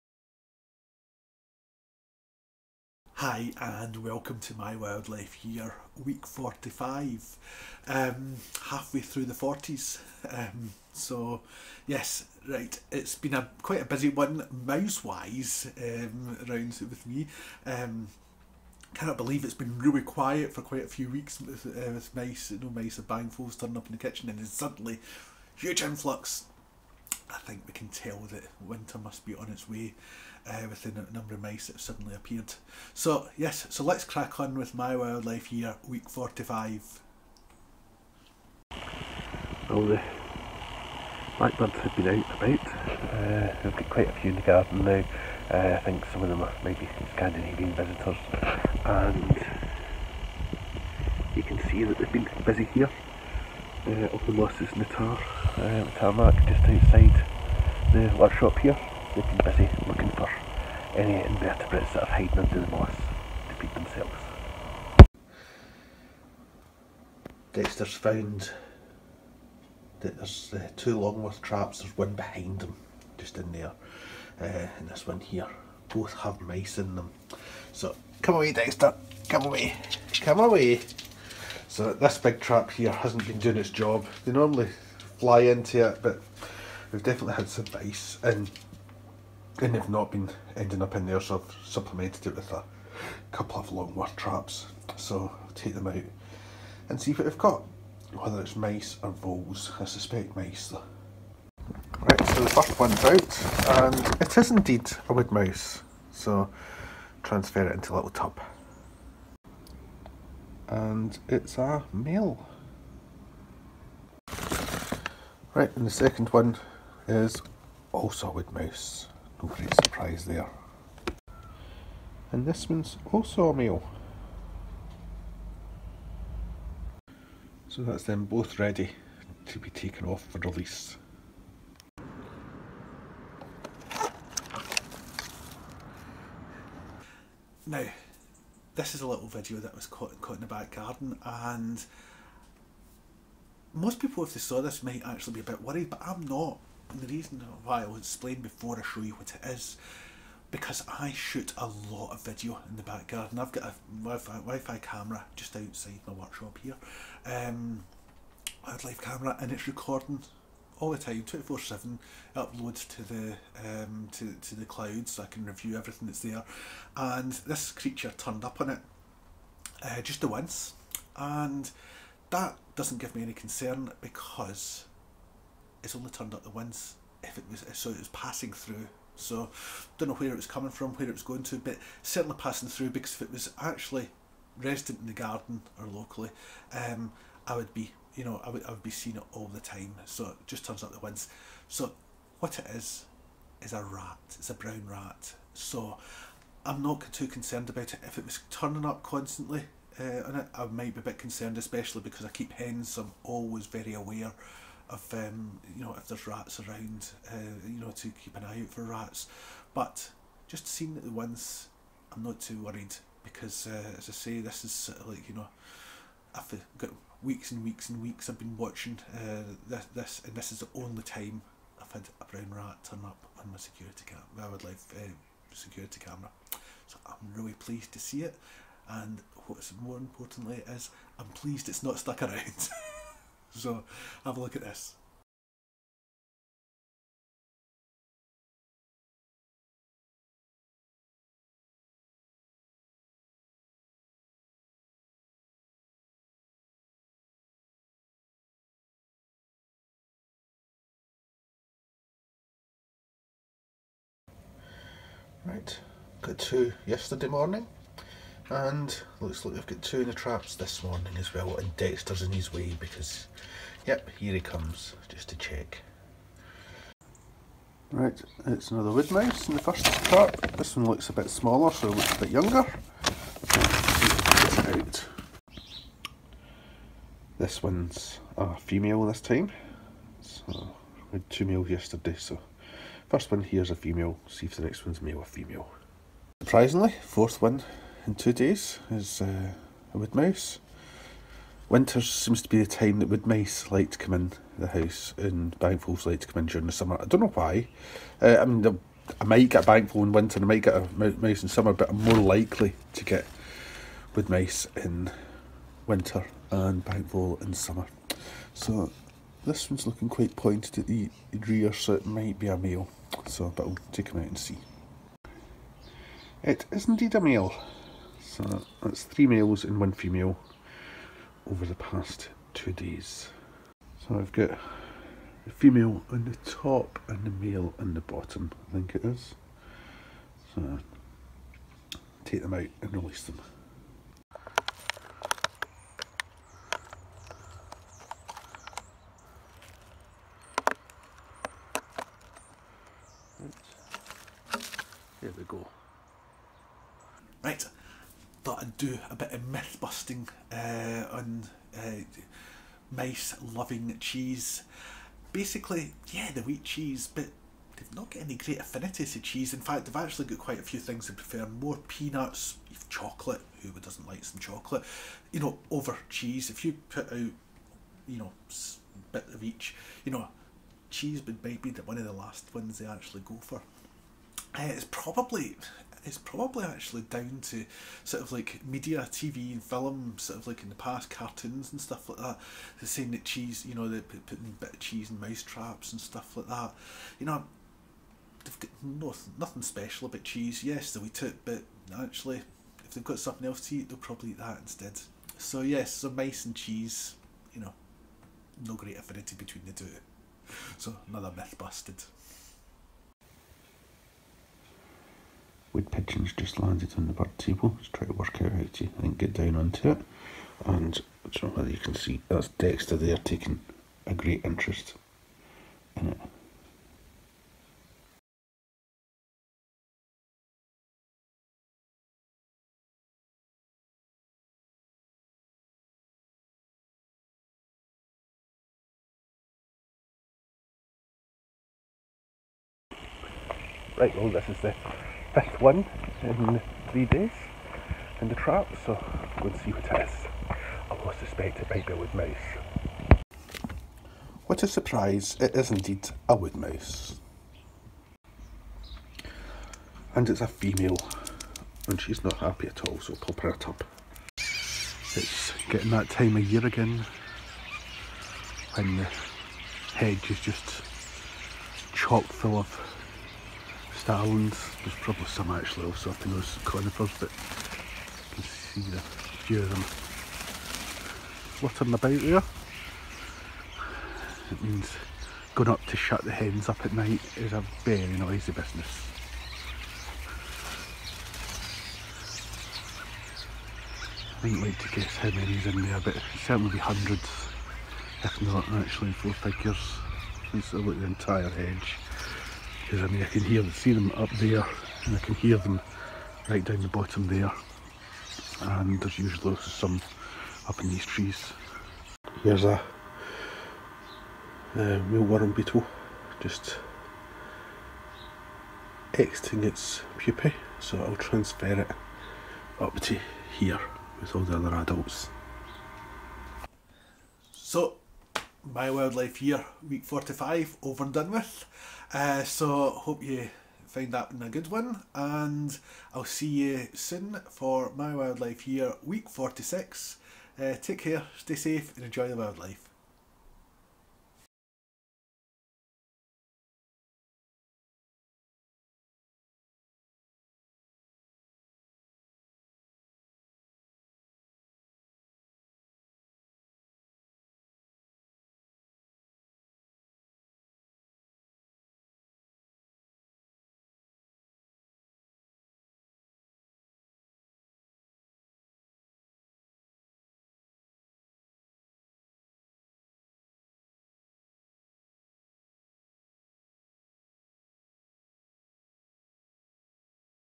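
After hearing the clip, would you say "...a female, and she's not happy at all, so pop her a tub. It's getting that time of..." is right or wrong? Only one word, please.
right.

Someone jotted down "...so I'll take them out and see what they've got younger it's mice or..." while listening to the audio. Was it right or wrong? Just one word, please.
wrong.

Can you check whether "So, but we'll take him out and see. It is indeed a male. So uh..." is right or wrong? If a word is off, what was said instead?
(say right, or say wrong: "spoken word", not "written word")
right.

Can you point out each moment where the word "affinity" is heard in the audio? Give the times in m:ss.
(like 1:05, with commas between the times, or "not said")
5:58, 6:38.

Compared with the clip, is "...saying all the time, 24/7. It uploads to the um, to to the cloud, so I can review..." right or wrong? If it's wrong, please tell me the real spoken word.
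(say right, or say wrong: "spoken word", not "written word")
wrong: "recording", not "saying".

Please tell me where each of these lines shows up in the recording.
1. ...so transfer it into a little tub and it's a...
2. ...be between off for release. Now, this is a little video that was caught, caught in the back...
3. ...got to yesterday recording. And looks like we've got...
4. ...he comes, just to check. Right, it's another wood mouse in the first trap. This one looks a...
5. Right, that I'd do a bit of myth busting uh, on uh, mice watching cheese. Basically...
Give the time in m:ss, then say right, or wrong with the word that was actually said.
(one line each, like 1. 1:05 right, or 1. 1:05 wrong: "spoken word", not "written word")
1. 1:46 right
2. 2:09 wrong: "taken", not "between"
3. 4:16 wrong: "morning", not "recording"
4. 4:24 right
5. 5:47 wrong: "loving", not "watching".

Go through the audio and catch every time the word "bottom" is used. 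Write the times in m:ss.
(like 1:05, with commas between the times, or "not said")
5:27, 8:16.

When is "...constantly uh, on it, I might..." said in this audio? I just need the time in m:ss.
3:19.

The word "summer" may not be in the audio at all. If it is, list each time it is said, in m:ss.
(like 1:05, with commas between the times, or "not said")
4:56, 5:01, 5:07.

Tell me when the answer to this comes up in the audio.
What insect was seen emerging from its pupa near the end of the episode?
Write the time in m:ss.
8:25.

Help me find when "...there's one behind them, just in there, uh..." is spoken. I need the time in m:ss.
1:11.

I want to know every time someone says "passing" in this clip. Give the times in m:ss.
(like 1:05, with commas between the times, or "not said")
2:58, 3:02.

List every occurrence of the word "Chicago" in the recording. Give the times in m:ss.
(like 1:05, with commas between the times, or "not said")
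not said.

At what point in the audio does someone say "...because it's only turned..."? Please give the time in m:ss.
2:54.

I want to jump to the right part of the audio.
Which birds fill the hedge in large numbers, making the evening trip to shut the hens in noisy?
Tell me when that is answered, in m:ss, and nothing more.
7:44.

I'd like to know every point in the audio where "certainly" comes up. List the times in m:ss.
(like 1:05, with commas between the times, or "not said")
3:02, 8:06.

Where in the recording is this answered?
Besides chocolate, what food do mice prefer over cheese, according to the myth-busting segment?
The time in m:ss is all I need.
6:01.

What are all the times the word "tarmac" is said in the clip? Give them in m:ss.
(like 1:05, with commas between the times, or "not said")
0:55.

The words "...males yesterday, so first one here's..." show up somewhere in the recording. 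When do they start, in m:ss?
4:41.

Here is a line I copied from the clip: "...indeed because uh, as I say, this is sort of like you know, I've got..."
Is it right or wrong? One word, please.
wrong.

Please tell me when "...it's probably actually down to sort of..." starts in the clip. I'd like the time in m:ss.
6:16.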